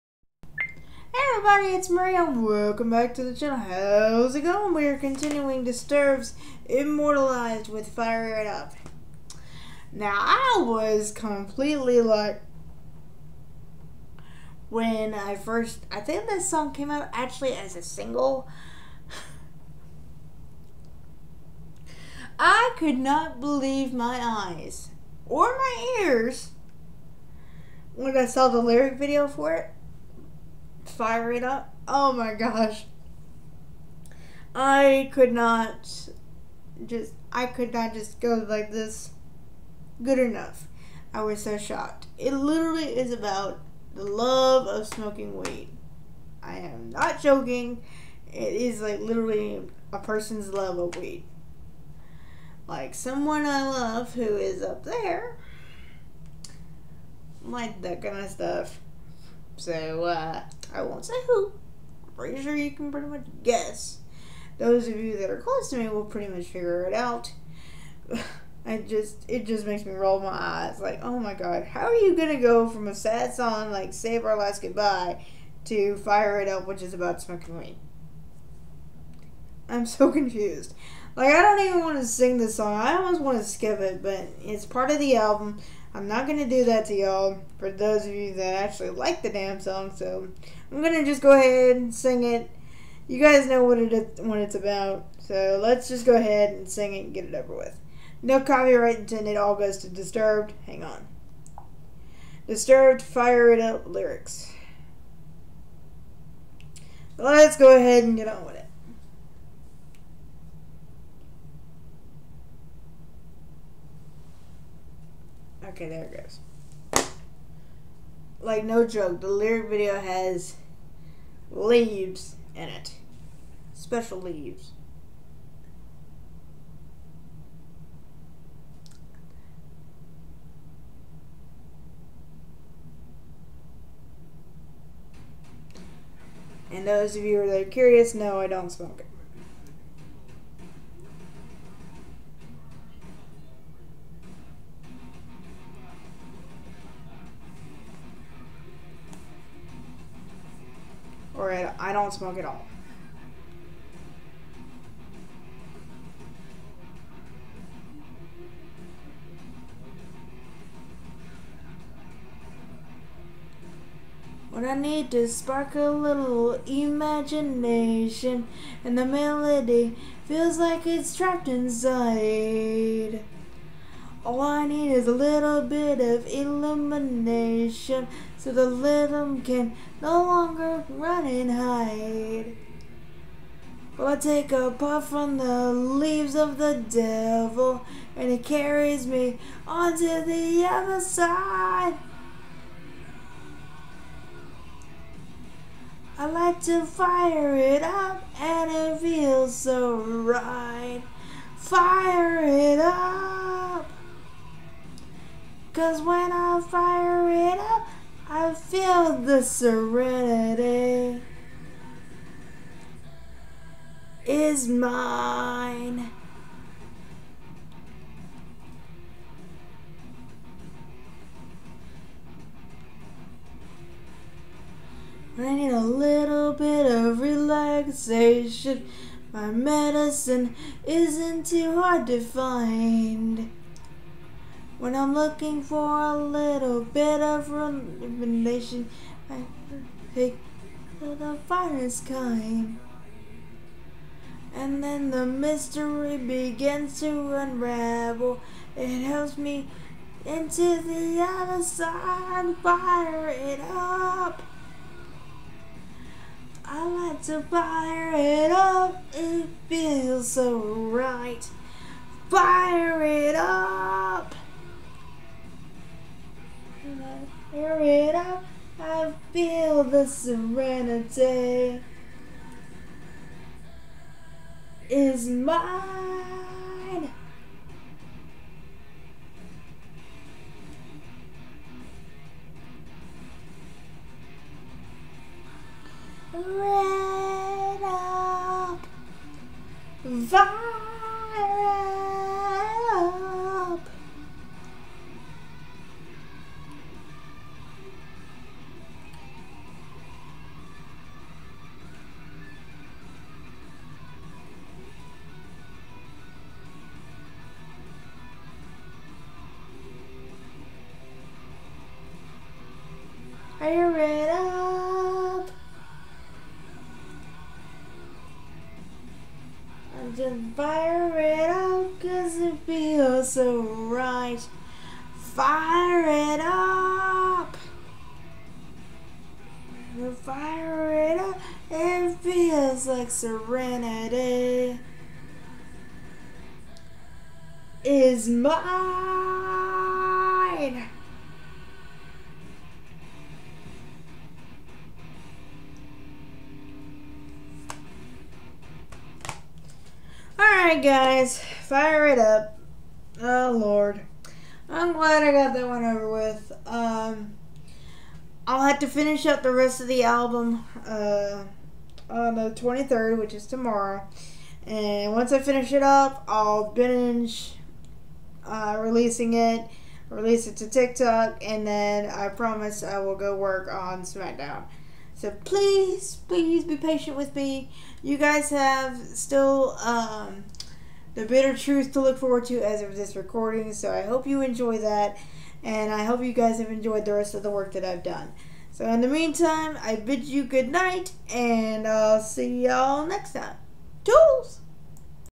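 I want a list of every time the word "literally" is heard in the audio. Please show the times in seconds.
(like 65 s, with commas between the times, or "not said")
42 s, 48 s.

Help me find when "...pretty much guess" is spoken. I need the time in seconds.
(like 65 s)
62 s.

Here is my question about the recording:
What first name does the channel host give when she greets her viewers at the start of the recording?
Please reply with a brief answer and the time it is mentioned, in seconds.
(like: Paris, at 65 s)
Maria, at 1 s.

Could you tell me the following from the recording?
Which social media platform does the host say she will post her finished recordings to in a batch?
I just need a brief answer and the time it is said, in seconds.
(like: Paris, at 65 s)
TikTok, at 370 s.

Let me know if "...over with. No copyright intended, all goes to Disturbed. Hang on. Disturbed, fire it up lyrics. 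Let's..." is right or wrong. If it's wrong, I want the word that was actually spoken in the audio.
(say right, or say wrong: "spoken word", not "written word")
right.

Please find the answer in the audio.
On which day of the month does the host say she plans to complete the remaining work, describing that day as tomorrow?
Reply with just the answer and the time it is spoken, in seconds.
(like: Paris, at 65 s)
23rd, at 362 s.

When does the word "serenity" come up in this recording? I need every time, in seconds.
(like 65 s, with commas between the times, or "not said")
209 s, 270 s, 333 s.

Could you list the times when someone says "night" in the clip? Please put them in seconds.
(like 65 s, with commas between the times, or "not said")
390 s.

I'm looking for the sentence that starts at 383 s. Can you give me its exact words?
So I hope you enjoy that, and I hope you guys have enjoyed the rest of the work that I've done.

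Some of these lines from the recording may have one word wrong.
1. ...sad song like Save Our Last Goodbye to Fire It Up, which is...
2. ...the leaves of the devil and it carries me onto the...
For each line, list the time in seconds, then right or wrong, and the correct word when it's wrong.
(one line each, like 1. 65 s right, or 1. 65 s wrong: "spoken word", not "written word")
1. 72 s right
2. 185 s right.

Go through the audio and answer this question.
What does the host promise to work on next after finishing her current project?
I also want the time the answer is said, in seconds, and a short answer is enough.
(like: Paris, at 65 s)
SmackDown, at 374 s.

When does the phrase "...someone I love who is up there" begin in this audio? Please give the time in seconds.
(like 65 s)
52 s.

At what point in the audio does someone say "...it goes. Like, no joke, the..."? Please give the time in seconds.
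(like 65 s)
116 s.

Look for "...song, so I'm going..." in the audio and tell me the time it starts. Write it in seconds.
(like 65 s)
89 s.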